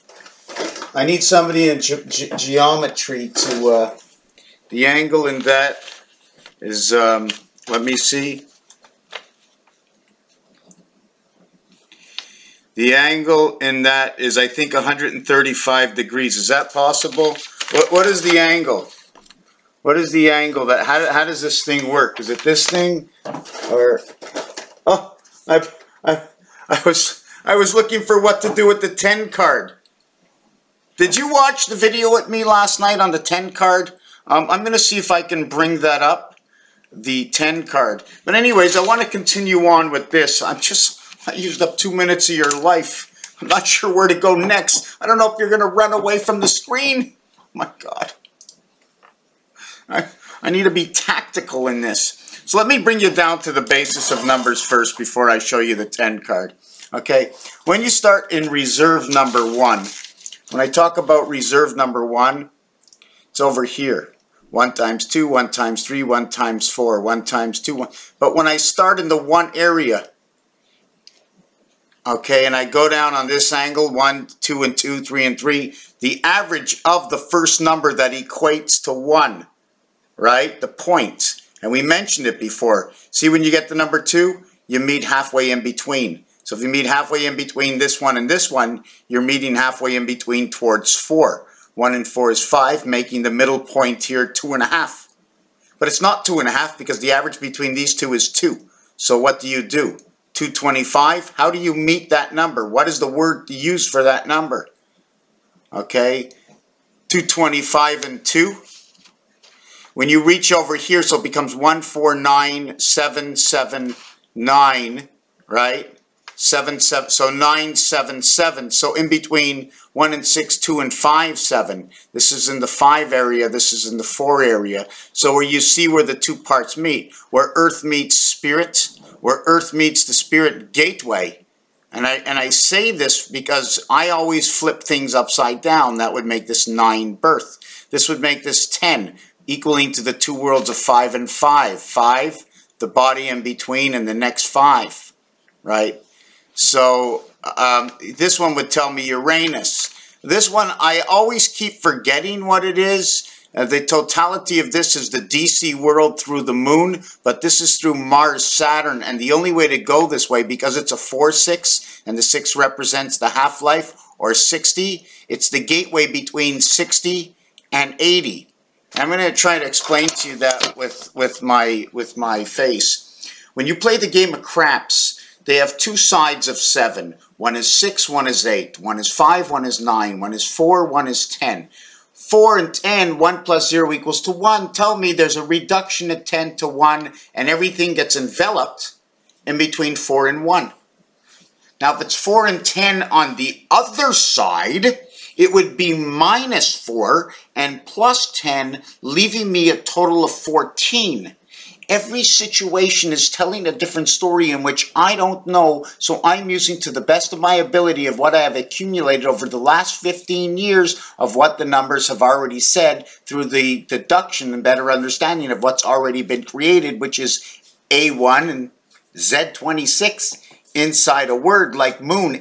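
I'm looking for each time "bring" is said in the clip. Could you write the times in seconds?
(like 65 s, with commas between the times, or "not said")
35 s, 52 s.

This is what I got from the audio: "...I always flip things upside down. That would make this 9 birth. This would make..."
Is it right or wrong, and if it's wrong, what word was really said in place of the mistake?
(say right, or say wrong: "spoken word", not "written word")
right.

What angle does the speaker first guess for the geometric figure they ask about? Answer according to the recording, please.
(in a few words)
135 degrees.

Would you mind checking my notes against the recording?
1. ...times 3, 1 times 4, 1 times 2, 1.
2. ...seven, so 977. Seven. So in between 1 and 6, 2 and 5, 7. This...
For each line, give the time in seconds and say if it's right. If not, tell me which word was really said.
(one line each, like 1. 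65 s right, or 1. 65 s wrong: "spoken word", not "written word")
1. 65 s right
2. 116 s right.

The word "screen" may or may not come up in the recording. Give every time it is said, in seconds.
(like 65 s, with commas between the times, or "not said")
46 s.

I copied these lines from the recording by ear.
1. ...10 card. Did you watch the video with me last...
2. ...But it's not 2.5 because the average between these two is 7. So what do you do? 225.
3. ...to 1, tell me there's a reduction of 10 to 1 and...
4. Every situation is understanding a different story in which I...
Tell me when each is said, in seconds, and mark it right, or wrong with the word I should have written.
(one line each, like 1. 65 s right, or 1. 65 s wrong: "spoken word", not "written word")
1. 28 s right
2. 95 s wrong: "2", not "7"
3. 184 s right
4. 201 s wrong: "telling", not "understanding".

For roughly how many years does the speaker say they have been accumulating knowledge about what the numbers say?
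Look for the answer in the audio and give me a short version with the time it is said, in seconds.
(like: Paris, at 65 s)
15 years, at 209 s.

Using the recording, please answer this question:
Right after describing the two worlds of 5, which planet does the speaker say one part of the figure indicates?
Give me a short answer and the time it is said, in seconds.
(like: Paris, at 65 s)
Uranus, at 149 s.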